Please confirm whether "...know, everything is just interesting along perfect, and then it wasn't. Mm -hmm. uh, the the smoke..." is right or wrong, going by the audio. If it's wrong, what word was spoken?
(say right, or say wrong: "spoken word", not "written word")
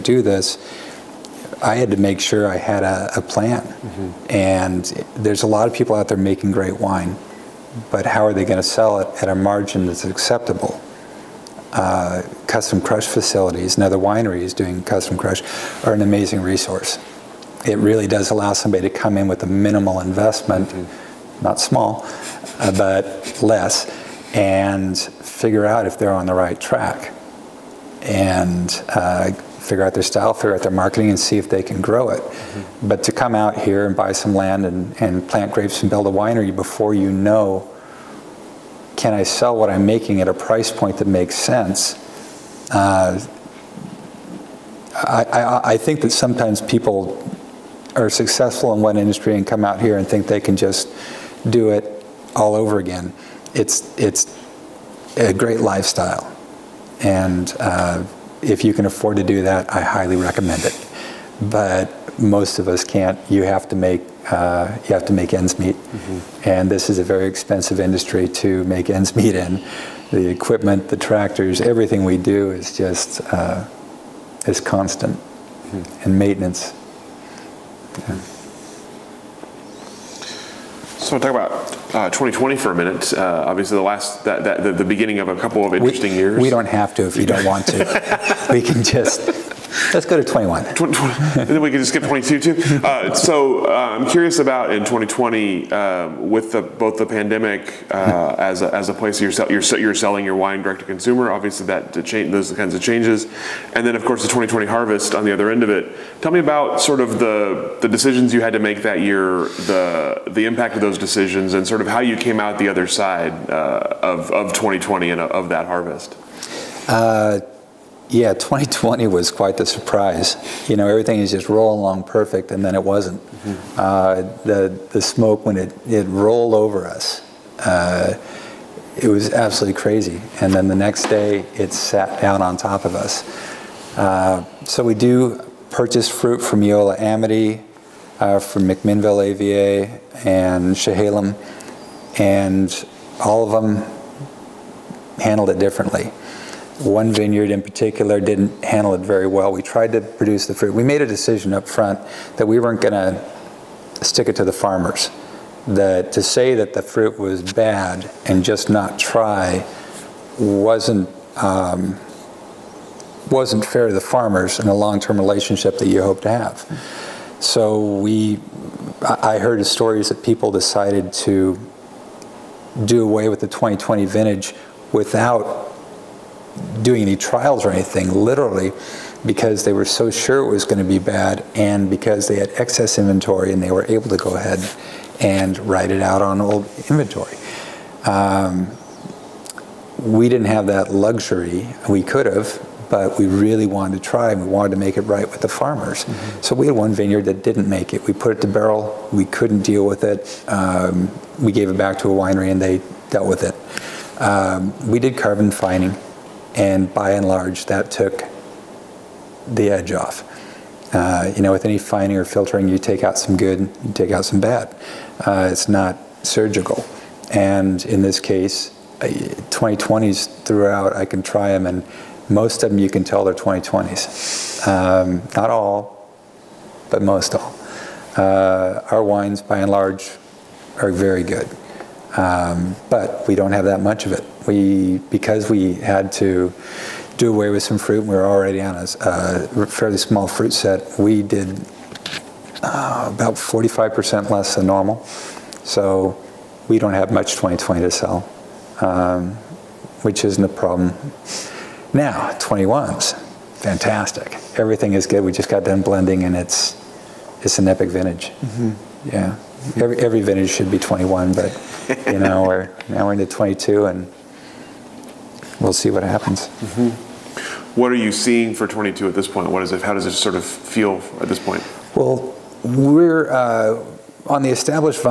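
wrong: "rolling", not "interesting".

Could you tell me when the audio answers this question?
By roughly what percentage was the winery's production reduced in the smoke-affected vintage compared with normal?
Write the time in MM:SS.
04:03.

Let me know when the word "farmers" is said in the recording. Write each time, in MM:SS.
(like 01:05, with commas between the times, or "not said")
02:34, 02:44, 03:15.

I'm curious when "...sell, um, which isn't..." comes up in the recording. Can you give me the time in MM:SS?
04:07.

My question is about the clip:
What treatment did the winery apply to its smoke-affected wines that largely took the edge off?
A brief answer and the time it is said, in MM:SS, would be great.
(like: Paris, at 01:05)
Carbon fining, at 03:25.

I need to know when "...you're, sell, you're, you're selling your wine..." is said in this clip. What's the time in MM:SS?
01:39.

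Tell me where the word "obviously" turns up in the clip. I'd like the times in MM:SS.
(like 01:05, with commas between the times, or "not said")
01:23, 01:41.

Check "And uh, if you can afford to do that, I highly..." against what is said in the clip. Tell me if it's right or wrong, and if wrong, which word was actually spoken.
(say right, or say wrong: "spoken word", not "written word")
right.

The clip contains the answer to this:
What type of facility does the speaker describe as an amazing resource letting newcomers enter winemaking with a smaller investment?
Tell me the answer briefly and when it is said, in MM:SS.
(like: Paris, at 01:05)
Custom crush facilities, at 00:12.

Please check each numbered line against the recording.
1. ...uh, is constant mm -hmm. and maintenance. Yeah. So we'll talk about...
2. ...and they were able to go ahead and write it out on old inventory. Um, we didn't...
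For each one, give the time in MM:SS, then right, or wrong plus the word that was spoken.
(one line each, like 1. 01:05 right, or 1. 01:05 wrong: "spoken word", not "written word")
1. 01:13 right
2. 03:03 right.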